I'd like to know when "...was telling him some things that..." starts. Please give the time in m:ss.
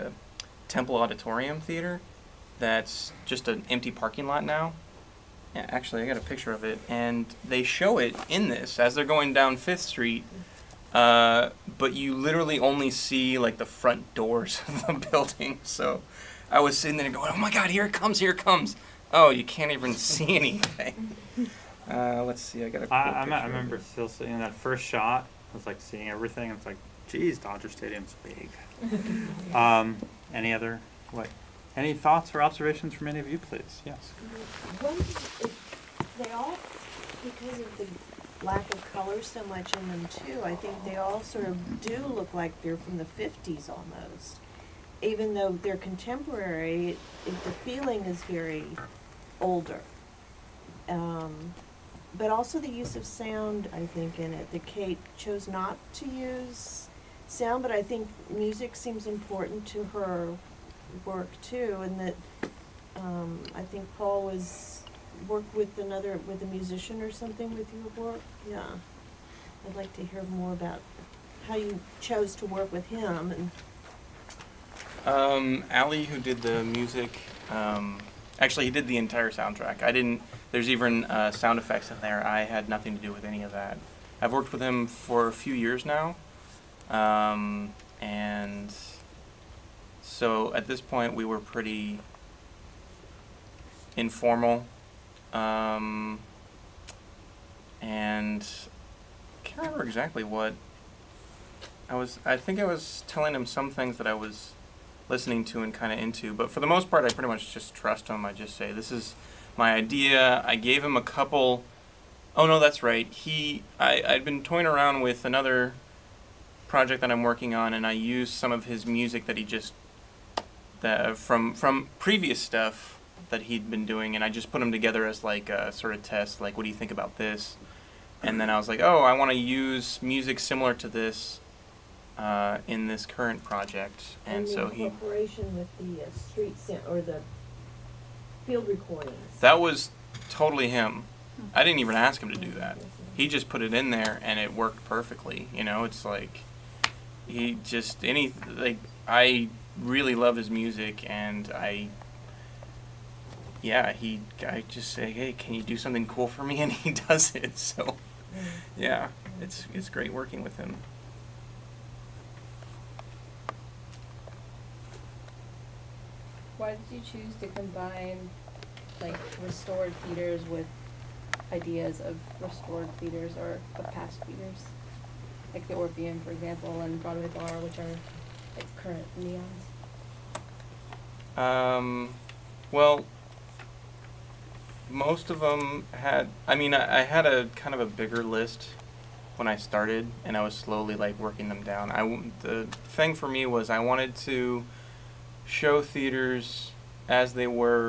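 1:42.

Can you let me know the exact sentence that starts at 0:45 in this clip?
Even though they're contemporary, it, the feeling is very older.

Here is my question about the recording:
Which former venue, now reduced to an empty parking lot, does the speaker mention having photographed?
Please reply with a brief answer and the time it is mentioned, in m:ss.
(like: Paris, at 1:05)
Temple Auditorium Theater, at 0:00.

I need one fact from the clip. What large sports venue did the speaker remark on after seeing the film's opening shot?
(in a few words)
Dodger Stadium.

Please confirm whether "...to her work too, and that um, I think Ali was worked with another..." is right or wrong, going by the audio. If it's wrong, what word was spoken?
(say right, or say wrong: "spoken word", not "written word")
wrong: "Paul", not "Ali".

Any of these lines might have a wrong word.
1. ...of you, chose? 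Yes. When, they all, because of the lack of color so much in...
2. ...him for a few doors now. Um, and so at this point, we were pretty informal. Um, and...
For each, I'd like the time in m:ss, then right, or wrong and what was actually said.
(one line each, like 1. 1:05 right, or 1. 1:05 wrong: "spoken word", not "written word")
1. 0:33 wrong: "please", not "chose"
2. 1:24 wrong: "years", not "doors".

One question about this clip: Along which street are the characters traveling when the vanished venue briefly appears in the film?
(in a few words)
Fifth Street.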